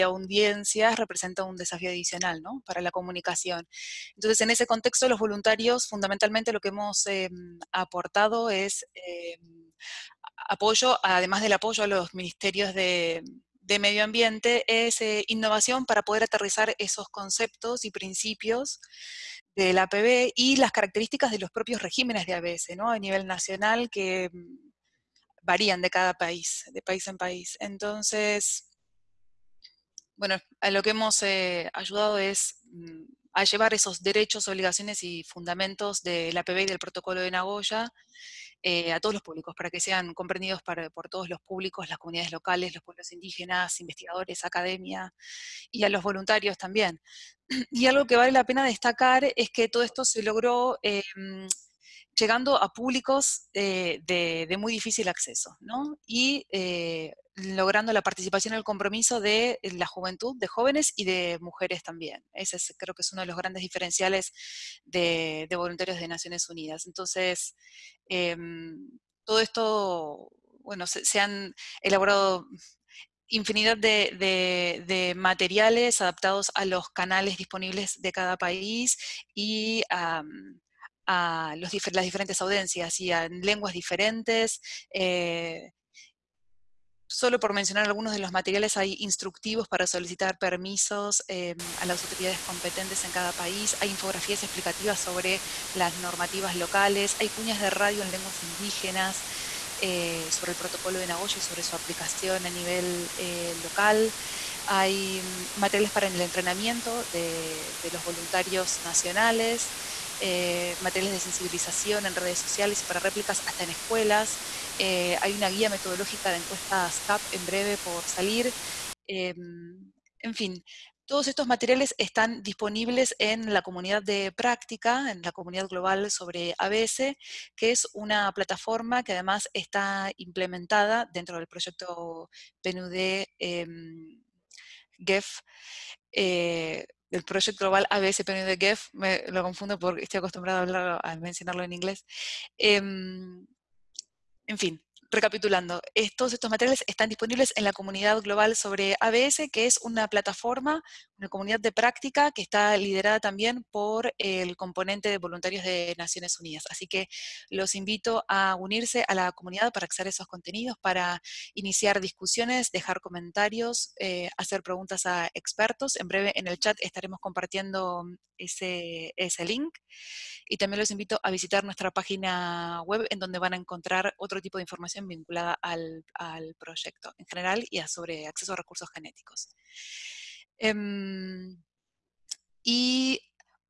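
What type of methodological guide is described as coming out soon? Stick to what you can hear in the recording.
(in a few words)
guía metodológica de encuestas.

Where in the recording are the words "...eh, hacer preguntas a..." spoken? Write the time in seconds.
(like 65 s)
163 s.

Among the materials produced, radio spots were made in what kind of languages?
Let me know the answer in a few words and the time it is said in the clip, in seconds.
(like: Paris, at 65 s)
lenguas indígenas, at 98 s.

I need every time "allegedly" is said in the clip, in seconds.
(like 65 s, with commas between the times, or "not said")
not said.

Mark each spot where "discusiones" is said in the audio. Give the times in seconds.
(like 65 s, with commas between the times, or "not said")
161 s.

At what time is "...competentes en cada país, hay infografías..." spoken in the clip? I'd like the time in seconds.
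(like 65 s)
92 s.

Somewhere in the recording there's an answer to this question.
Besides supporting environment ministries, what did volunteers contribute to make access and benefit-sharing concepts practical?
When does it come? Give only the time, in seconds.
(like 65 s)
15 s.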